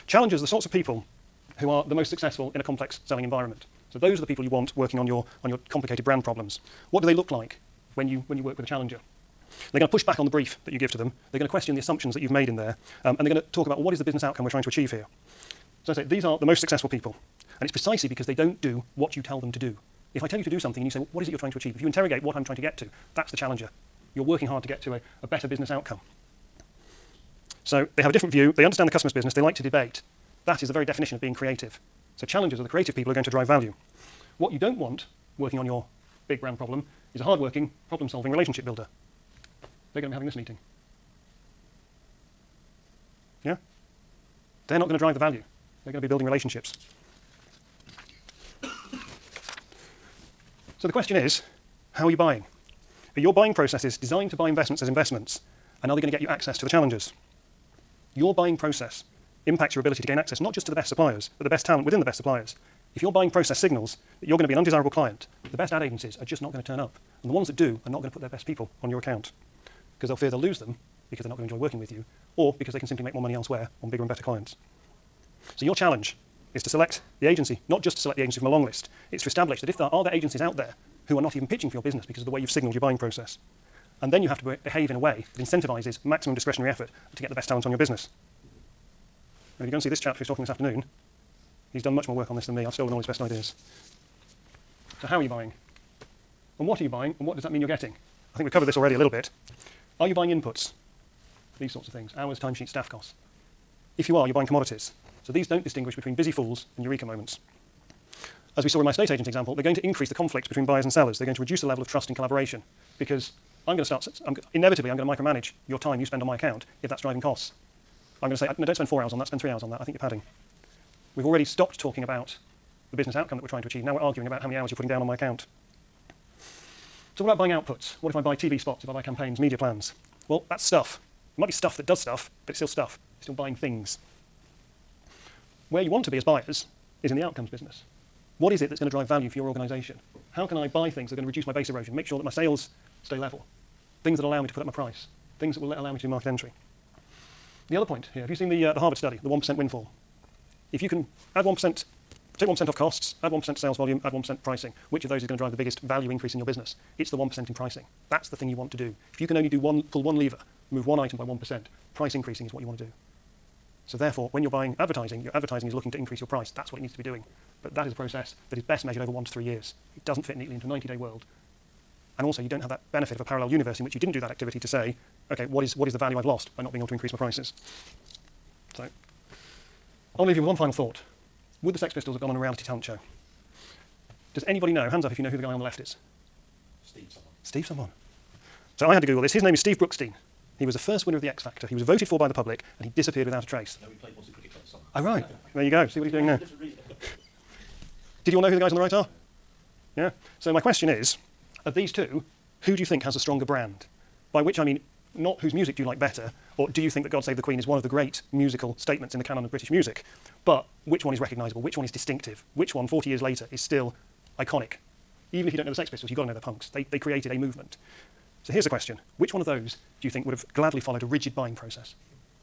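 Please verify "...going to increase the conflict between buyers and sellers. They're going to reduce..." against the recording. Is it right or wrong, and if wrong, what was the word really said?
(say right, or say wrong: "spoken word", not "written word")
right.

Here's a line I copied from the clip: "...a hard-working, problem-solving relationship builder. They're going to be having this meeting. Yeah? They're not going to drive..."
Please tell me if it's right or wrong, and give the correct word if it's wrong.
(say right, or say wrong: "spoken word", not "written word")
right.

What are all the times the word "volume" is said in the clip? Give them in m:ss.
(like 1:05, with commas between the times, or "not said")
2:33.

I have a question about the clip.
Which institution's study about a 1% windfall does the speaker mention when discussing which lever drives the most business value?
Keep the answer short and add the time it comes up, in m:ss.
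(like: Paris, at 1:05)
Harvard, at 2:28.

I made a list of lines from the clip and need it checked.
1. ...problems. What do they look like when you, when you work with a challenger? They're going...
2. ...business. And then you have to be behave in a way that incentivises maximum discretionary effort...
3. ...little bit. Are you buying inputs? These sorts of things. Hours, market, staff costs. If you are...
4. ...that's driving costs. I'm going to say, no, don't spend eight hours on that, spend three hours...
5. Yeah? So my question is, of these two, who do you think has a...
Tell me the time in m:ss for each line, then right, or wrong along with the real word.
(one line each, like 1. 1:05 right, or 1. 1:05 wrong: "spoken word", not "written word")
1. 0:06 right
2. 1:22 wrong: "process", not "business"
3. 1:38 wrong: "timesheet", not "market"
4. 1:56 wrong: "four", not "eight"
5. 3:19 right.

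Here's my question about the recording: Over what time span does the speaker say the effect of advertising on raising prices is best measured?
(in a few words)
1 to 3 years.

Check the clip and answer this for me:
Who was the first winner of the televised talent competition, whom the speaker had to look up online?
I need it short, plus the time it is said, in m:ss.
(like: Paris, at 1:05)
Steve Brookstein, at 3:09.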